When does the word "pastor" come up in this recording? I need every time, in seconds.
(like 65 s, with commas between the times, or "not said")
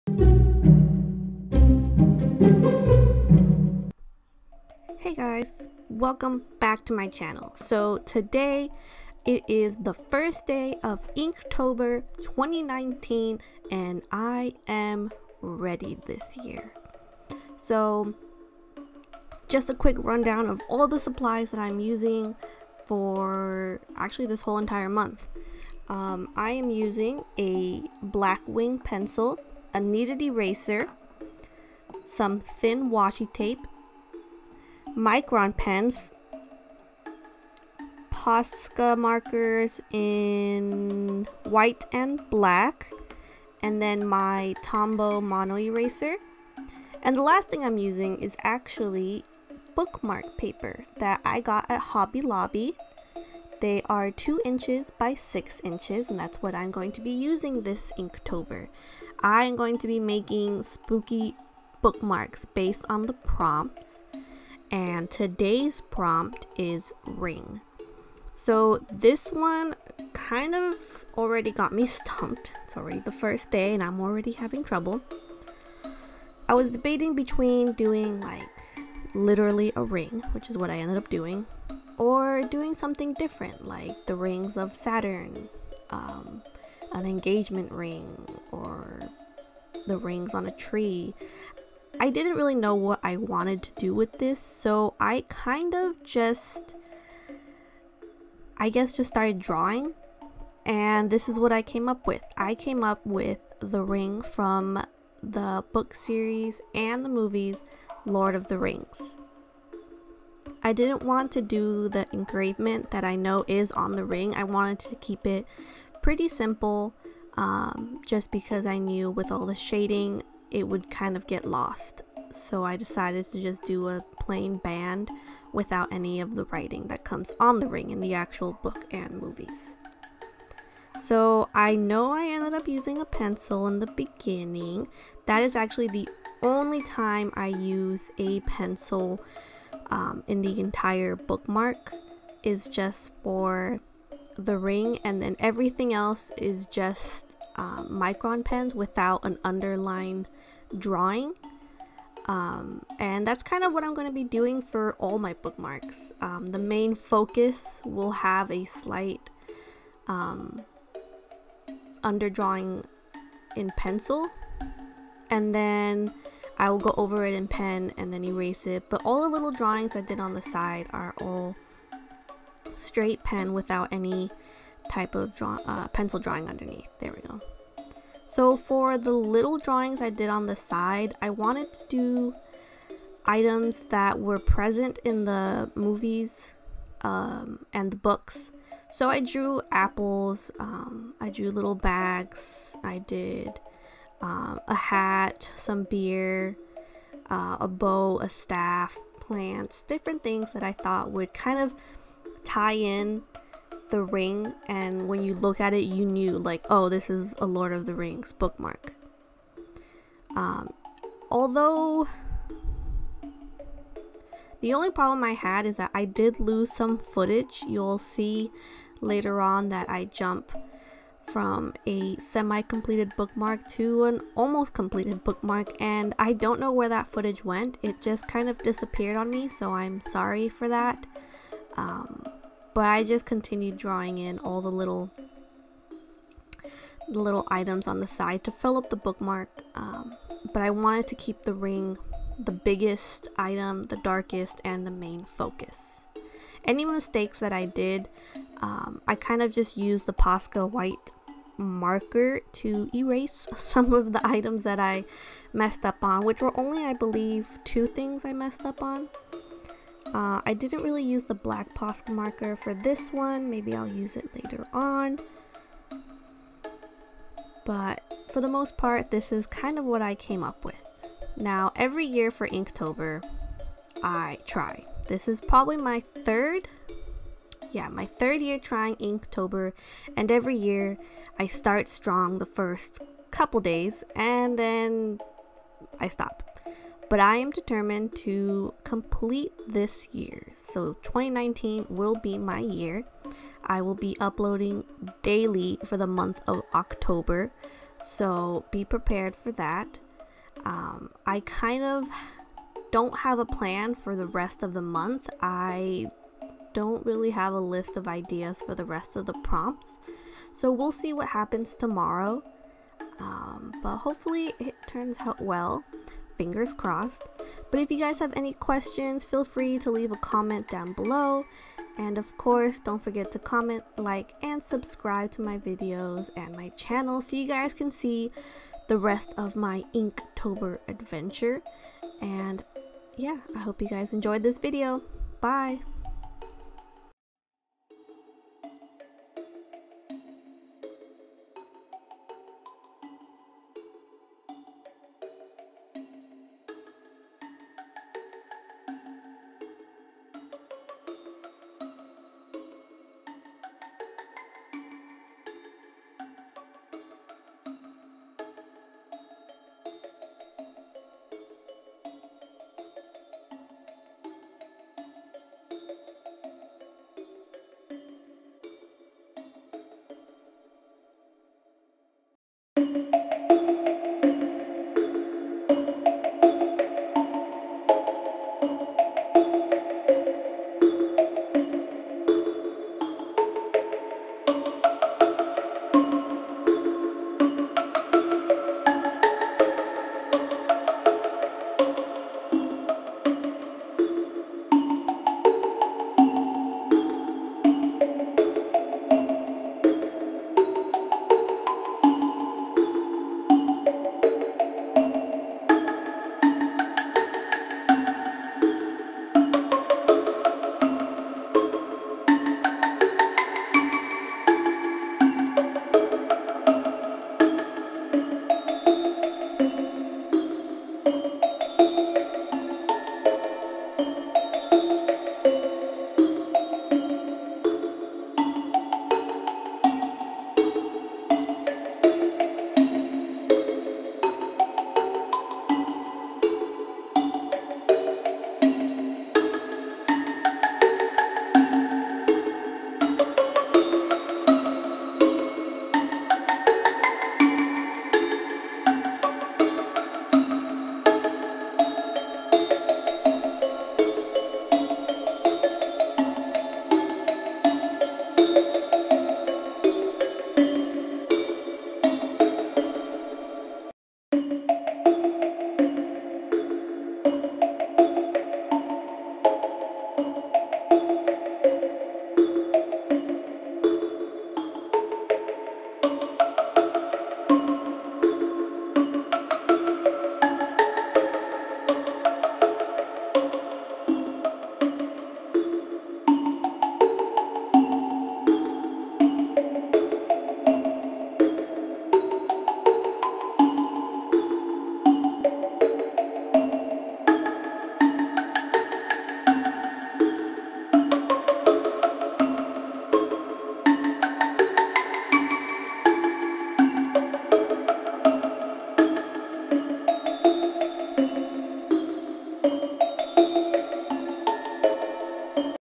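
not said.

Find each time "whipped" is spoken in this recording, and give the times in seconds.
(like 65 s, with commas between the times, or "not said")
not said.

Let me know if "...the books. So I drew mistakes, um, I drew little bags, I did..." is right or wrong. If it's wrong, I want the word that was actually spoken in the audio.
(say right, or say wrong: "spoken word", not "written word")
wrong: "apples", not "mistakes".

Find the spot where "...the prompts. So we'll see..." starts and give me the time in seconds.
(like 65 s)
309 s.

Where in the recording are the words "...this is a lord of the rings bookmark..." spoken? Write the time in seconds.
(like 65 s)
206 s.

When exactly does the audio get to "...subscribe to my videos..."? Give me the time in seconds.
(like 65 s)
324 s.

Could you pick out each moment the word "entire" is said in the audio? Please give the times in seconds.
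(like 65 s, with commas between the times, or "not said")
24 s, 140 s.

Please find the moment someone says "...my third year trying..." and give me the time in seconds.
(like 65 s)
277 s.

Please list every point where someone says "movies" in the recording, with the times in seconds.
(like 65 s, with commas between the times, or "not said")
107 s, 129 s, 185 s.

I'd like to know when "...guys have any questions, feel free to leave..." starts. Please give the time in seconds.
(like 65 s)
317 s.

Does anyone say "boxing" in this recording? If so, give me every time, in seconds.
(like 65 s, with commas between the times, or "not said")
not said.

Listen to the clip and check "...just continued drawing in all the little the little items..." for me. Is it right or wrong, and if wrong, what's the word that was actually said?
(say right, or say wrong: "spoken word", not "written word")
right.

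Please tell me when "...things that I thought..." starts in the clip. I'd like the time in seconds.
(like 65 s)
200 s.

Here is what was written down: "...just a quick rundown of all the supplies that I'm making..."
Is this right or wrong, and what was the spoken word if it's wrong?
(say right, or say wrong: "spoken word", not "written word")
wrong: "using", not "making".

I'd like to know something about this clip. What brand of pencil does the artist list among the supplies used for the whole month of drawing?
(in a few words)
Blackwing.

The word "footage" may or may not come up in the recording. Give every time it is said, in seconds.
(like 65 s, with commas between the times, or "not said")
216 s, 227 s.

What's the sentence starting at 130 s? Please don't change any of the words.
So I know I ended up using a pencil in the beginning.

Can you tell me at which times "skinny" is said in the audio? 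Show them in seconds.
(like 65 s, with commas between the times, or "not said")
not said.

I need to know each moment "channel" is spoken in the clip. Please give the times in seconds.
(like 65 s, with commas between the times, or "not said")
7 s, 326 s.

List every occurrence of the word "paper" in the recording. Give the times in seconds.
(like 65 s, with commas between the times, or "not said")
50 s.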